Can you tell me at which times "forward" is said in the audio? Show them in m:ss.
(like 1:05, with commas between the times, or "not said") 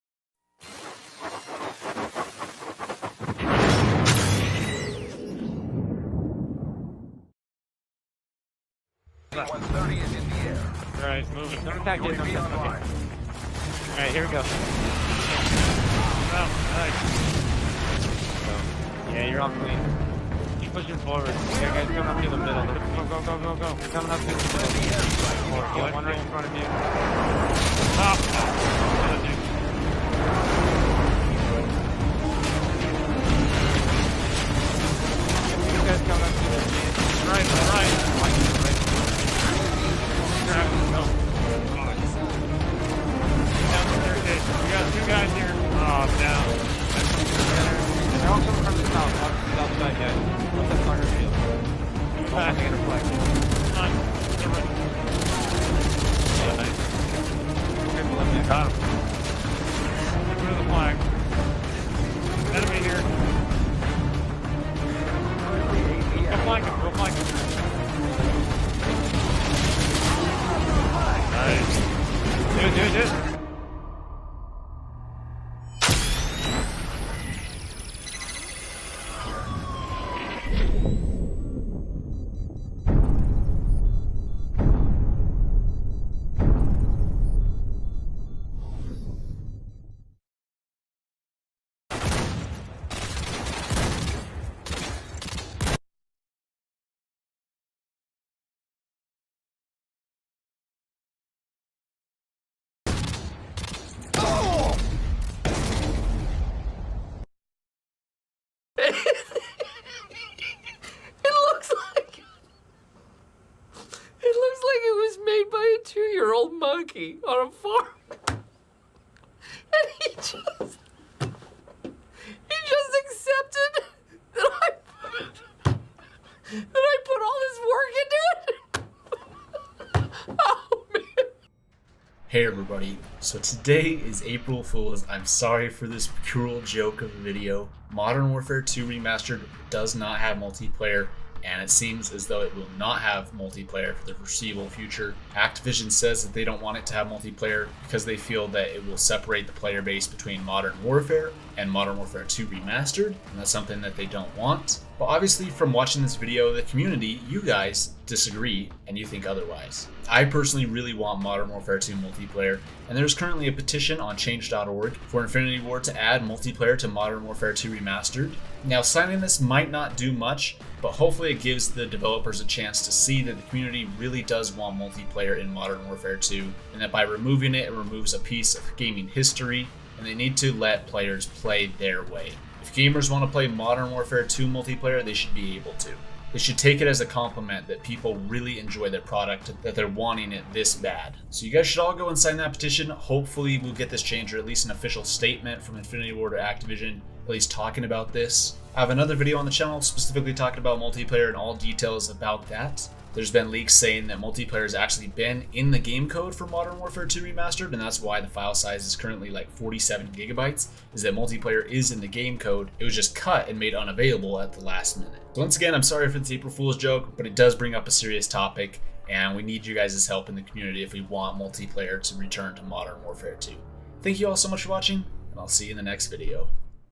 0:20.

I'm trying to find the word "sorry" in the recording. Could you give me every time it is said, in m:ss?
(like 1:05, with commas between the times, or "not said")
2:15, 3:35.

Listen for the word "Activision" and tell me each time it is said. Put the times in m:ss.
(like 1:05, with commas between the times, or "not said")
2:25, 3:16.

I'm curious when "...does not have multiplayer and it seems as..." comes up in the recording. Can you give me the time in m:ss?
2:19.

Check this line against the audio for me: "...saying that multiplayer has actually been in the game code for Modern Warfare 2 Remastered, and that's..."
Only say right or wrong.
right.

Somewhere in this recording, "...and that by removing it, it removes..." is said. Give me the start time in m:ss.
2:56.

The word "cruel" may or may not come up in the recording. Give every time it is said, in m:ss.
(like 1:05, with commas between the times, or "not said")
2:16.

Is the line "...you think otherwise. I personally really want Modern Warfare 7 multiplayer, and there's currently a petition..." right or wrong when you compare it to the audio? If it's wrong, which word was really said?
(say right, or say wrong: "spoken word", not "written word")
wrong: "2", not "7".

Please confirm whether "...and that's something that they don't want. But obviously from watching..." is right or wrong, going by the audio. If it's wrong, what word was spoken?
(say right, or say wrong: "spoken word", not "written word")
right.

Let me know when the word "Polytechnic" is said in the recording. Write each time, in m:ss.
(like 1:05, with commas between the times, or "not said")
not said.